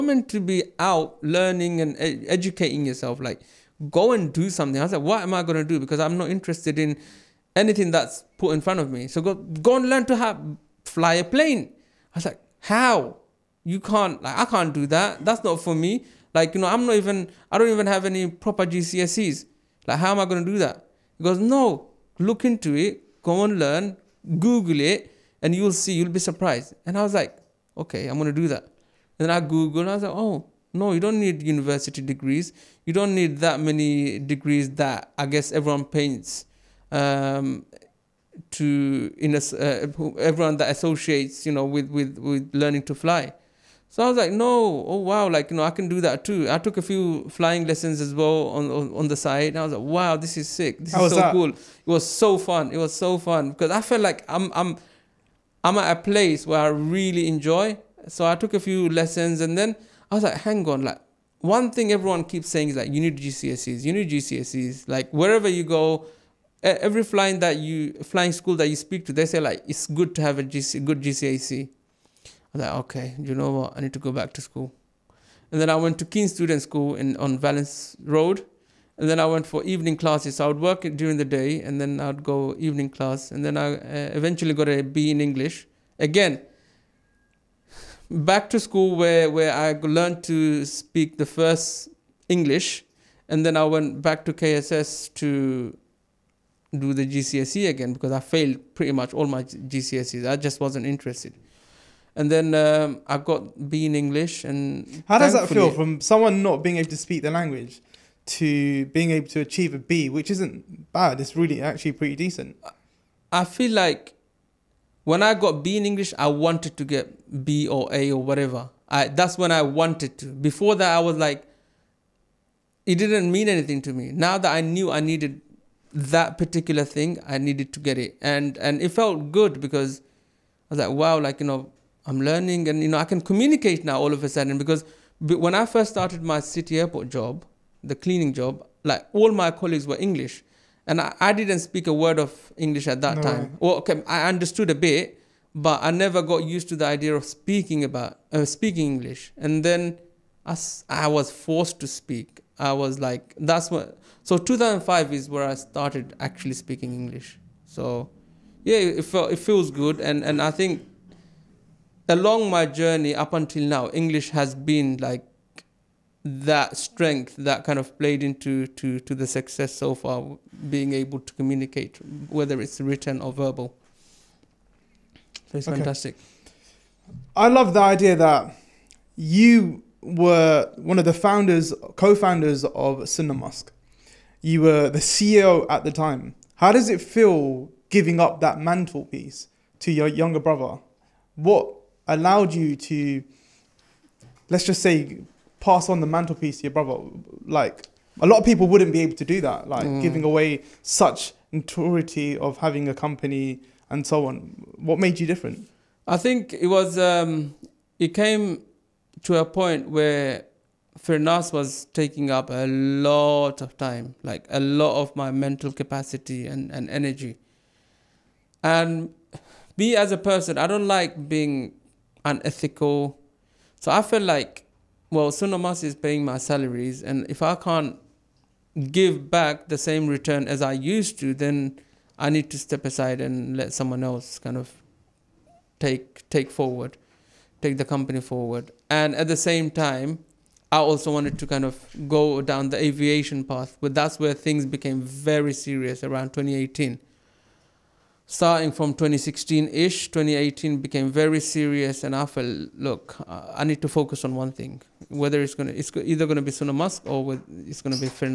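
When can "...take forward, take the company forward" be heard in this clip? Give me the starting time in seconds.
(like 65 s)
236 s.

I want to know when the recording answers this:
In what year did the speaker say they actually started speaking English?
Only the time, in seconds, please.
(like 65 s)
154 s.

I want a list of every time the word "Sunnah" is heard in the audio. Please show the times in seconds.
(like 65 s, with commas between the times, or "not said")
183 s, 225 s, 256 s.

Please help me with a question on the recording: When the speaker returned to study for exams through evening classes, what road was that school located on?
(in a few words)
Vallance Road.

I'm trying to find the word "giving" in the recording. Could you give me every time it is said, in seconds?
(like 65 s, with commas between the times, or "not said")
187 s, 200 s.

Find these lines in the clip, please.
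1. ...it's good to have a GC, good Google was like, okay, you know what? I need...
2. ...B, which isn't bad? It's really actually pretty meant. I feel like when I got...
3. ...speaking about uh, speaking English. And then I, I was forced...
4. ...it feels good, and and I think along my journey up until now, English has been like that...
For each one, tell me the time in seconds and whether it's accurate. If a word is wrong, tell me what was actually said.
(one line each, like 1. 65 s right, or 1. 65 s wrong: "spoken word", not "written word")
1. 69 s wrong: "GCSE", not "Google"
2. 109 s wrong: "decent", not "meant"
3. 147 s right
4. 159 s right.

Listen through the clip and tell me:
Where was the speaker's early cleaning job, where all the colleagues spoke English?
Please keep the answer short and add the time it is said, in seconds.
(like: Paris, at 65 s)
City Airport, at 136 s.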